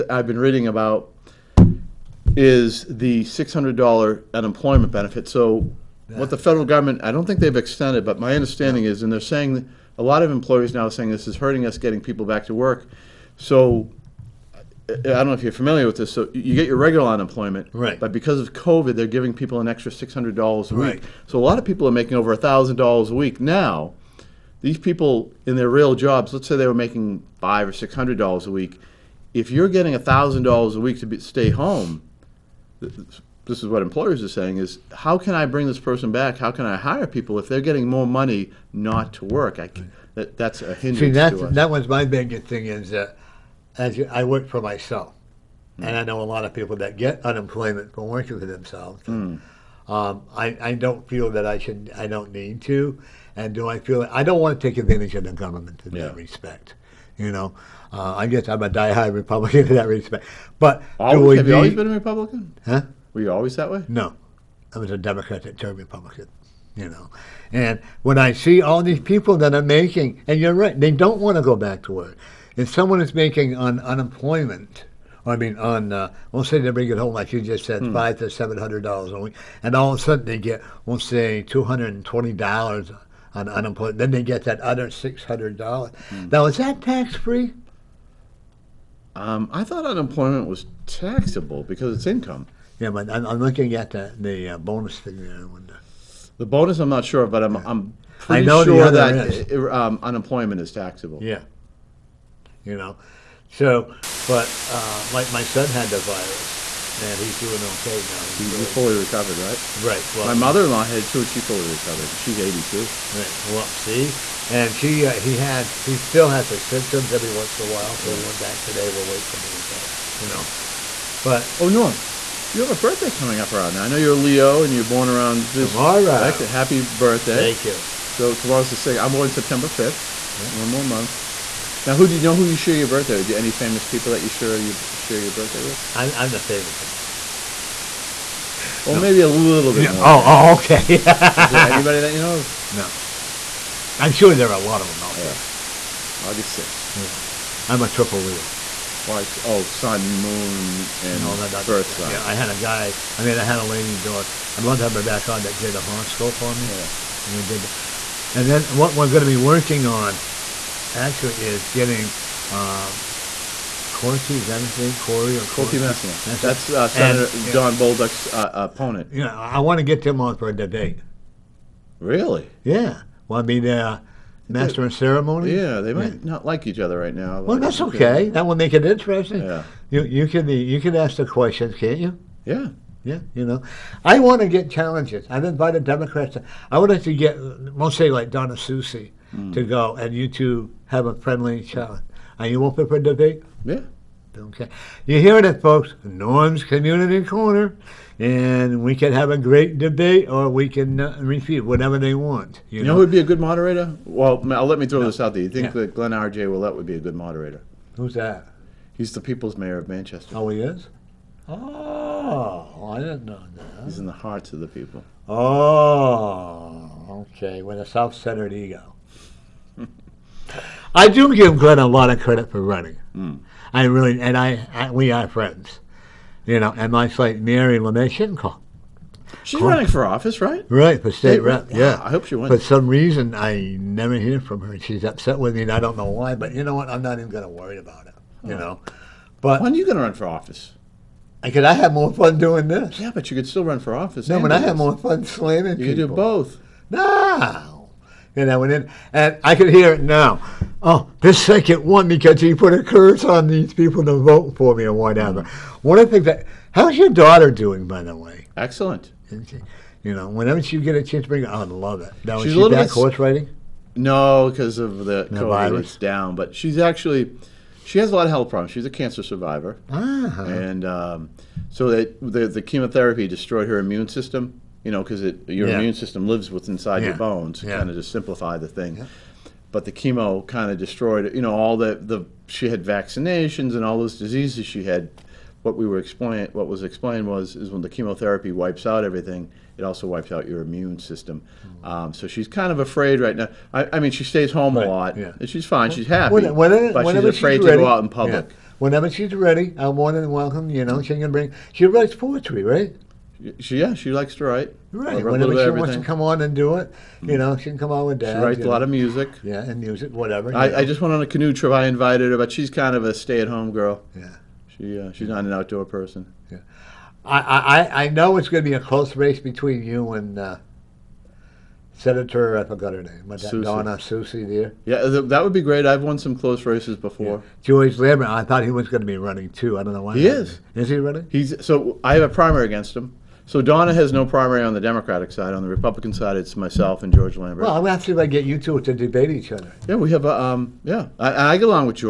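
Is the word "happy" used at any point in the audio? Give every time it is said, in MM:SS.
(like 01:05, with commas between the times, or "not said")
02:06, 04:56.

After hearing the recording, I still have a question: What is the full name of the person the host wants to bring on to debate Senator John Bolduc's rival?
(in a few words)
Corky Messina.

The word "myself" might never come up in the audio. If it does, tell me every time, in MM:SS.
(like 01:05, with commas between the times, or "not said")
00:44, 05:36.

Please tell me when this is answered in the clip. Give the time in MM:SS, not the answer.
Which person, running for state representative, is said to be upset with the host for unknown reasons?
03:47.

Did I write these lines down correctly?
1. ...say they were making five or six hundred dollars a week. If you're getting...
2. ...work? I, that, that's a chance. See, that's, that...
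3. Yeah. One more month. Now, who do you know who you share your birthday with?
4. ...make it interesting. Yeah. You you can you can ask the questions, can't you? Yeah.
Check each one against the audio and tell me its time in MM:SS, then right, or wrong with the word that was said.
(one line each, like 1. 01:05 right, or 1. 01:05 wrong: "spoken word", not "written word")
1. 00:26 right
2. 00:39 wrong: "hindrance", not "chance"
3. 02:10 right
4. 02:58 right.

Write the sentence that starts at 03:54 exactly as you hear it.
She's upset with me, and I don't know why, but you know what?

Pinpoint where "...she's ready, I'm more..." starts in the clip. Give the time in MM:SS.
04:59.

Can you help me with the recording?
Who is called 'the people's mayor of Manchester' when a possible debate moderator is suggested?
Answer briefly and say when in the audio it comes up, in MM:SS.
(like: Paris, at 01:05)
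Glenn R.J. Ouellette, at 03:25.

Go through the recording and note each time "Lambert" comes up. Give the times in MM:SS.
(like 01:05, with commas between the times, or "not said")
05:27, 05:37.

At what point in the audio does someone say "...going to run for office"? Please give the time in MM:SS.
03:59.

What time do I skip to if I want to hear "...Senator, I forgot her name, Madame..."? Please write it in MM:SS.
05:21.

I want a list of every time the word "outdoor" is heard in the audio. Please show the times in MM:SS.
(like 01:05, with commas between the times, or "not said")
05:15.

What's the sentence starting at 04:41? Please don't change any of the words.
you know, all the the she had vaccinations and all those diseases she had.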